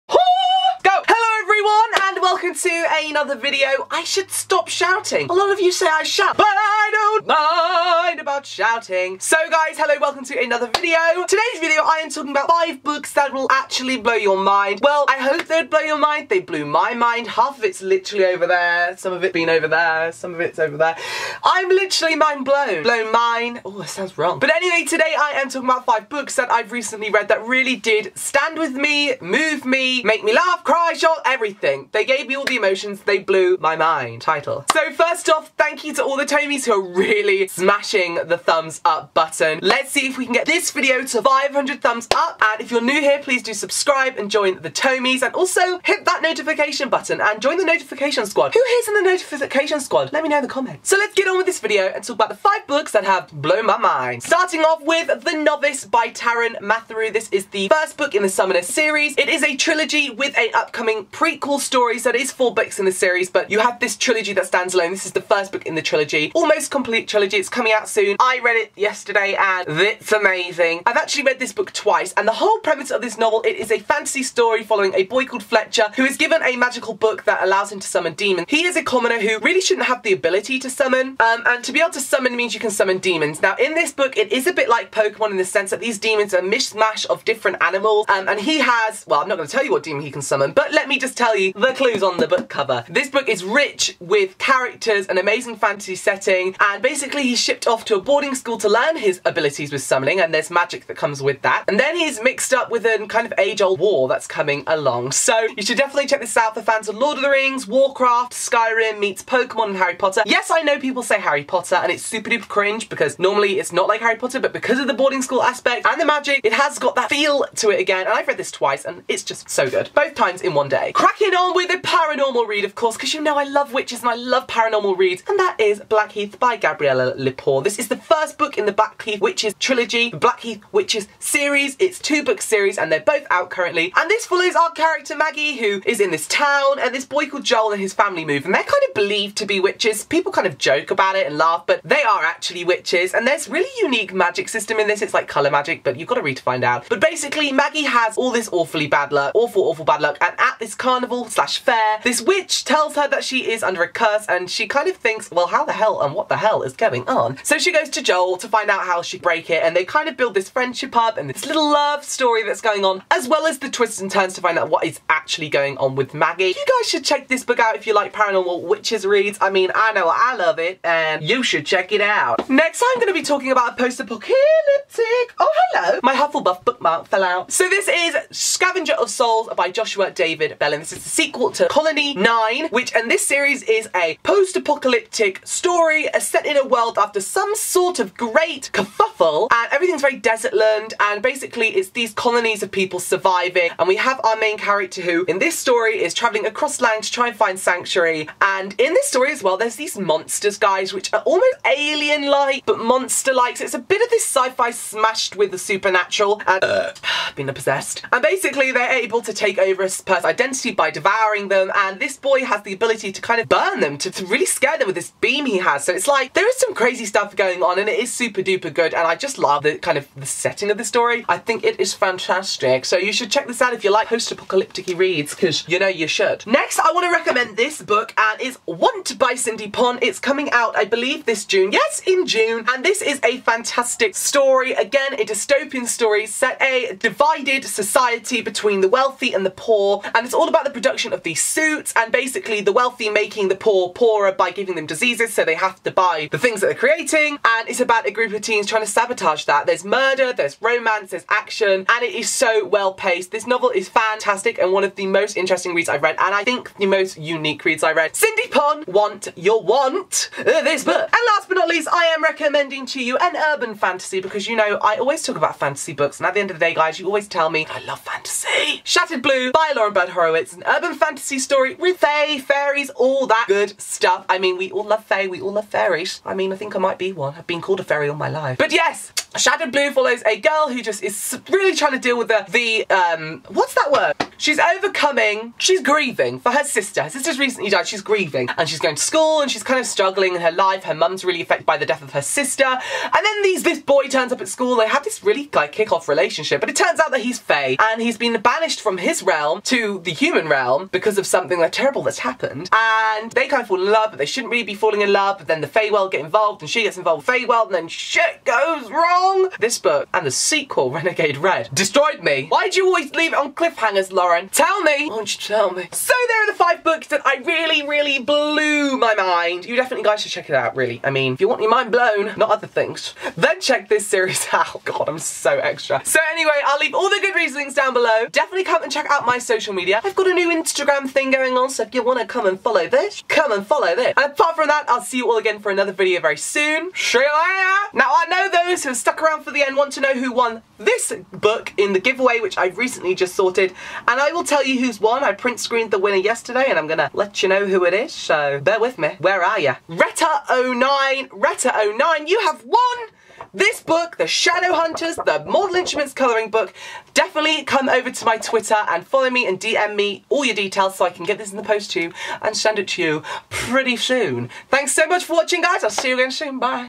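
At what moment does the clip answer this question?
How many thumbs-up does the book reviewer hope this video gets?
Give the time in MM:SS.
00:41.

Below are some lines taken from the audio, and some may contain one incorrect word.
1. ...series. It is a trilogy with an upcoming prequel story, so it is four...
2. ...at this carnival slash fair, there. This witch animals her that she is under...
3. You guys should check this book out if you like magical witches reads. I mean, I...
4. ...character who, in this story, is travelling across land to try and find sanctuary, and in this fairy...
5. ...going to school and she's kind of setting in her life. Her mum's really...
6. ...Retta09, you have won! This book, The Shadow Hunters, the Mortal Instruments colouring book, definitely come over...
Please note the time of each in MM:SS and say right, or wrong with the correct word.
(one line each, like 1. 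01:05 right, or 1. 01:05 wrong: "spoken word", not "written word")
1. 00:58 right
2. 02:30 wrong: "tells", not "animals"
3. 02:46 wrong: "paranormal", not "magical"
4. 03:14 wrong: "story", not "fairy"
5. 04:48 wrong: "struggling", not "setting"
6. 05:51 right.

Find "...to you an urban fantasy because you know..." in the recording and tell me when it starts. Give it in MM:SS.
04:22.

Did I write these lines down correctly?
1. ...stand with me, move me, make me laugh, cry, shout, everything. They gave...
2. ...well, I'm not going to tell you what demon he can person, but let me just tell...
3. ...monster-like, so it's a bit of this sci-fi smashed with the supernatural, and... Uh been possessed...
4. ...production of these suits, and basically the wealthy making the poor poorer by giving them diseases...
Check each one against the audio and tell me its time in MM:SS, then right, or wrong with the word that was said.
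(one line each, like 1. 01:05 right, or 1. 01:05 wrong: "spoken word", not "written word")
1. 00:28 right
2. 01:29 wrong: "summon", not "person"
3. 03:22 right
4. 04:00 right.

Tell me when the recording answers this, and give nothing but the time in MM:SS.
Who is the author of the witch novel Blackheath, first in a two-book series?
02:06.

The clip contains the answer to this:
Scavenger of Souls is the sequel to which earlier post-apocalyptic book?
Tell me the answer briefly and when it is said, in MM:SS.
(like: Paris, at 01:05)
Colony 9, at 03:01.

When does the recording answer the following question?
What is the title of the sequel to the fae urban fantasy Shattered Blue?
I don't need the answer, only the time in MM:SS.
05:10.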